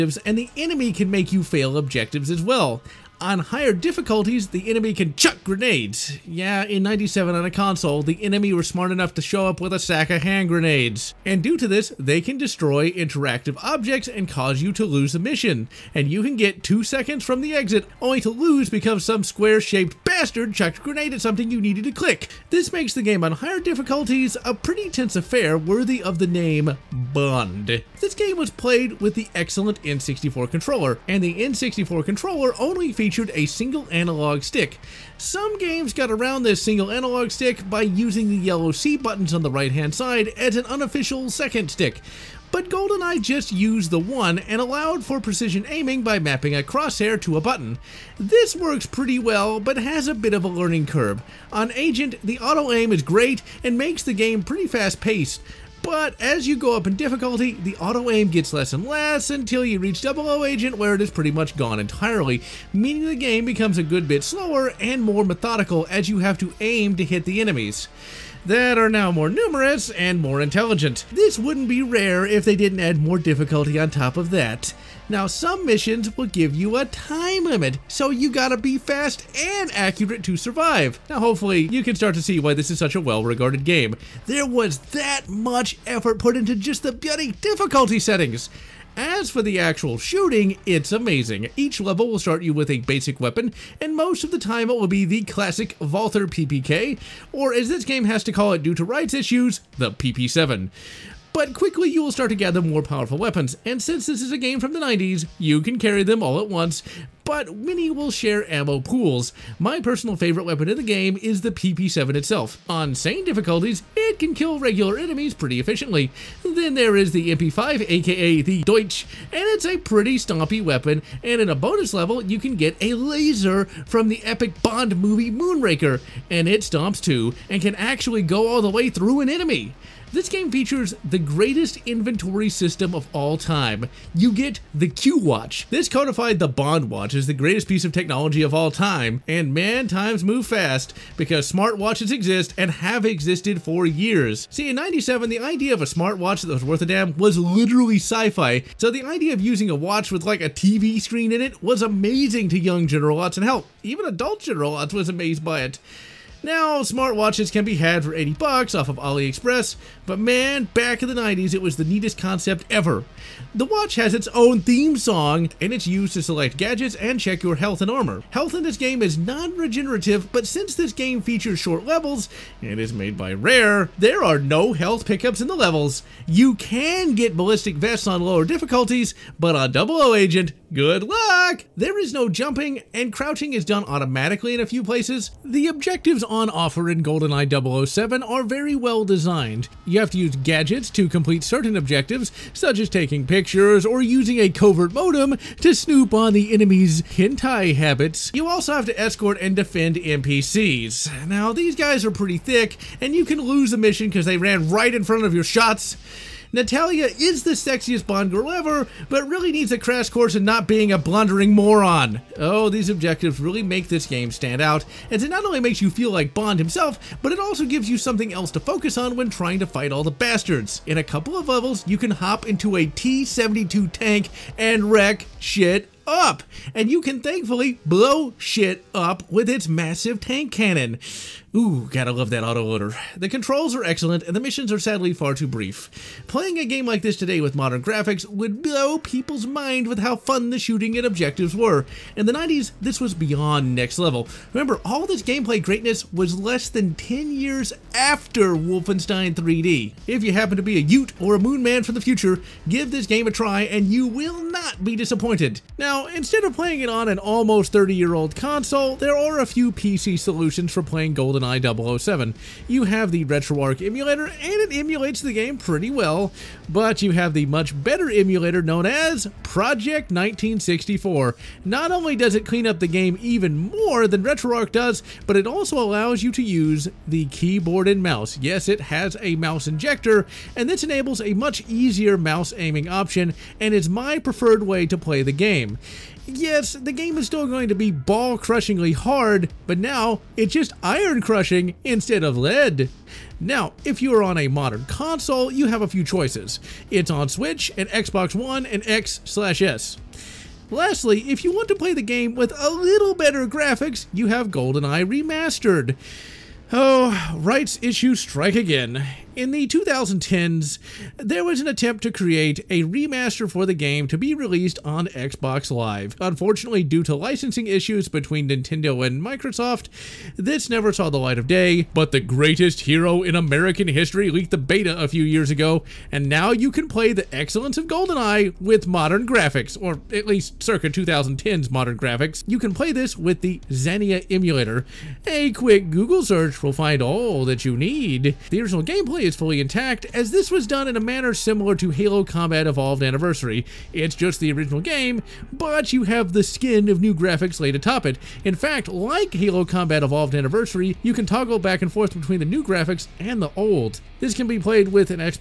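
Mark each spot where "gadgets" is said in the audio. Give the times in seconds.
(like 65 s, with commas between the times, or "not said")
166 s, 190 s.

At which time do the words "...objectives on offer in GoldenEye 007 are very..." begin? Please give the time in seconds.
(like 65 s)
185 s.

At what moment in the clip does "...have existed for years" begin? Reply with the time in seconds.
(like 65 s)
142 s.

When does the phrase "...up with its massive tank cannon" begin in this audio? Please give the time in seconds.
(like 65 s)
228 s.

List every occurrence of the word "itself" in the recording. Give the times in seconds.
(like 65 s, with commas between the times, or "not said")
112 s.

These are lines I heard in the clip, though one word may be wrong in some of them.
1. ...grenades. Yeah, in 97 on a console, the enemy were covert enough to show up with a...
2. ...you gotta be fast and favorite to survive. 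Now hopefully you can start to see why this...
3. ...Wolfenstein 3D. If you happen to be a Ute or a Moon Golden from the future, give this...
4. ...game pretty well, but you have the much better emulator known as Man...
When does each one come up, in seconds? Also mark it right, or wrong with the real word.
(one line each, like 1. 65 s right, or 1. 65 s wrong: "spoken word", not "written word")
1. 5 s wrong: "smart", not "covert"
2. 78 s wrong: "accurate", not "favorite"
3. 248 s wrong: "Man", not "Golden"
4. 265 s wrong: "Project", not "Man".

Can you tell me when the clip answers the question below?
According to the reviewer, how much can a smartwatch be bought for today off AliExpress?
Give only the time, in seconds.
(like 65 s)
158 s.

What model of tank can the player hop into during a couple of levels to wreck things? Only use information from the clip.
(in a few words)
T-72.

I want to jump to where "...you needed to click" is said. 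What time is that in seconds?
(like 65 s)
21 s.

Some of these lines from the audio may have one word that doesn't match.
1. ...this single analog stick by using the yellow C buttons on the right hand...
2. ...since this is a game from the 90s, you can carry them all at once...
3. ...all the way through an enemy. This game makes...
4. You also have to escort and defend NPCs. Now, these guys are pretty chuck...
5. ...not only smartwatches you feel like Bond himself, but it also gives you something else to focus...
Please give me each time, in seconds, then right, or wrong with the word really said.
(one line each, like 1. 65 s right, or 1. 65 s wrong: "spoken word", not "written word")
1. 36 s right
2. 103 s right
3. 128 s wrong: "features", not "makes"
4. 198 s wrong: "thick", not "chuck"
5. 215 s wrong: "makes", not "smartwatches".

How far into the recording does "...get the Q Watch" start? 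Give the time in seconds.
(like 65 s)
134 s.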